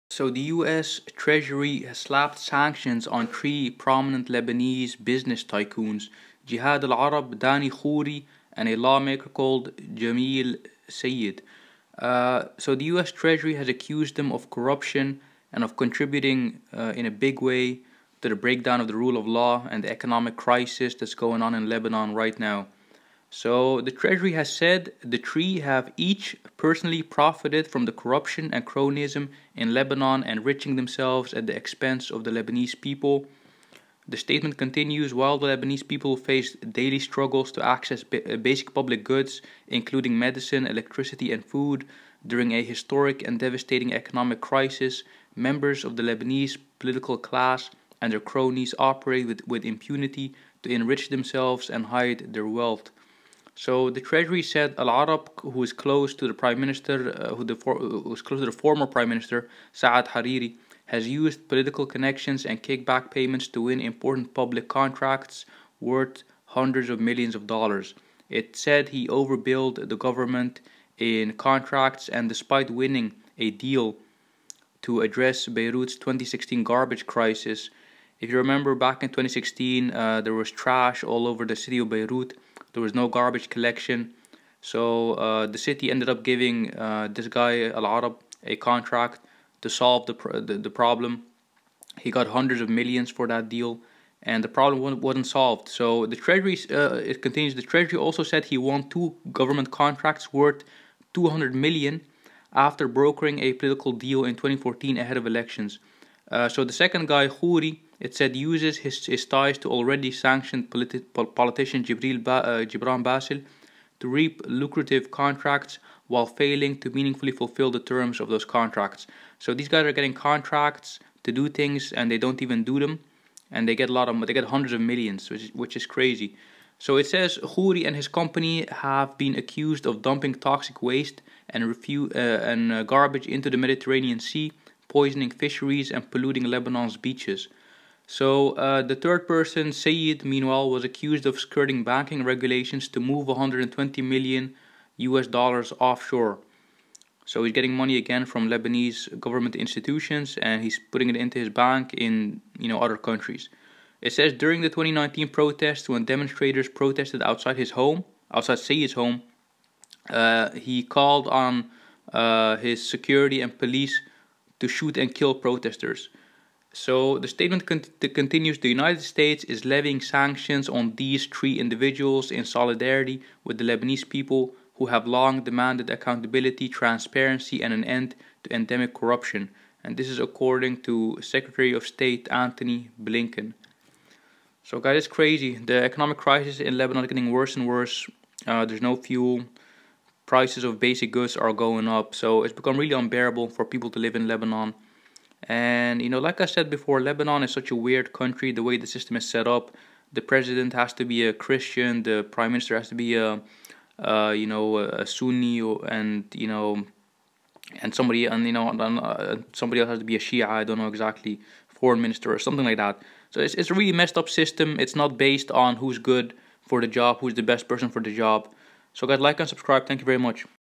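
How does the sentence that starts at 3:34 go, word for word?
It's not based on who's good for the job, who's the best person for the job.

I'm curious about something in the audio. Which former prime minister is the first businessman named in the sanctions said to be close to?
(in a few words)
Saad Hariri.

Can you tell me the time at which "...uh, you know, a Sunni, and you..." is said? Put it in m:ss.
3:23.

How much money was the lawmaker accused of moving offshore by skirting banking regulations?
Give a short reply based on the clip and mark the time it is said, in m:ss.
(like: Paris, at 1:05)
120 million US dollars, at 2:23.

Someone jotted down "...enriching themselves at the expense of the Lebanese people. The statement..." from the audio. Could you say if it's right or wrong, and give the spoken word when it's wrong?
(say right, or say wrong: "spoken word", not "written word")
right.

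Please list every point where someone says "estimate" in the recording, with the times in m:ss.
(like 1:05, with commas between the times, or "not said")
not said.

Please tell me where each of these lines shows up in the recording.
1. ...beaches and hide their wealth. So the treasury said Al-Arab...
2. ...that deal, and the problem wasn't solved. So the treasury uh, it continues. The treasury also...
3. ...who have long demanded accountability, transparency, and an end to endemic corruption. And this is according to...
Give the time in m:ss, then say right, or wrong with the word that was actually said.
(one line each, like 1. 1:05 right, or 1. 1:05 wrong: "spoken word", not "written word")
1. 0:51 wrong: "themselves", not "beaches"
2. 1:33 right
3. 2:54 right.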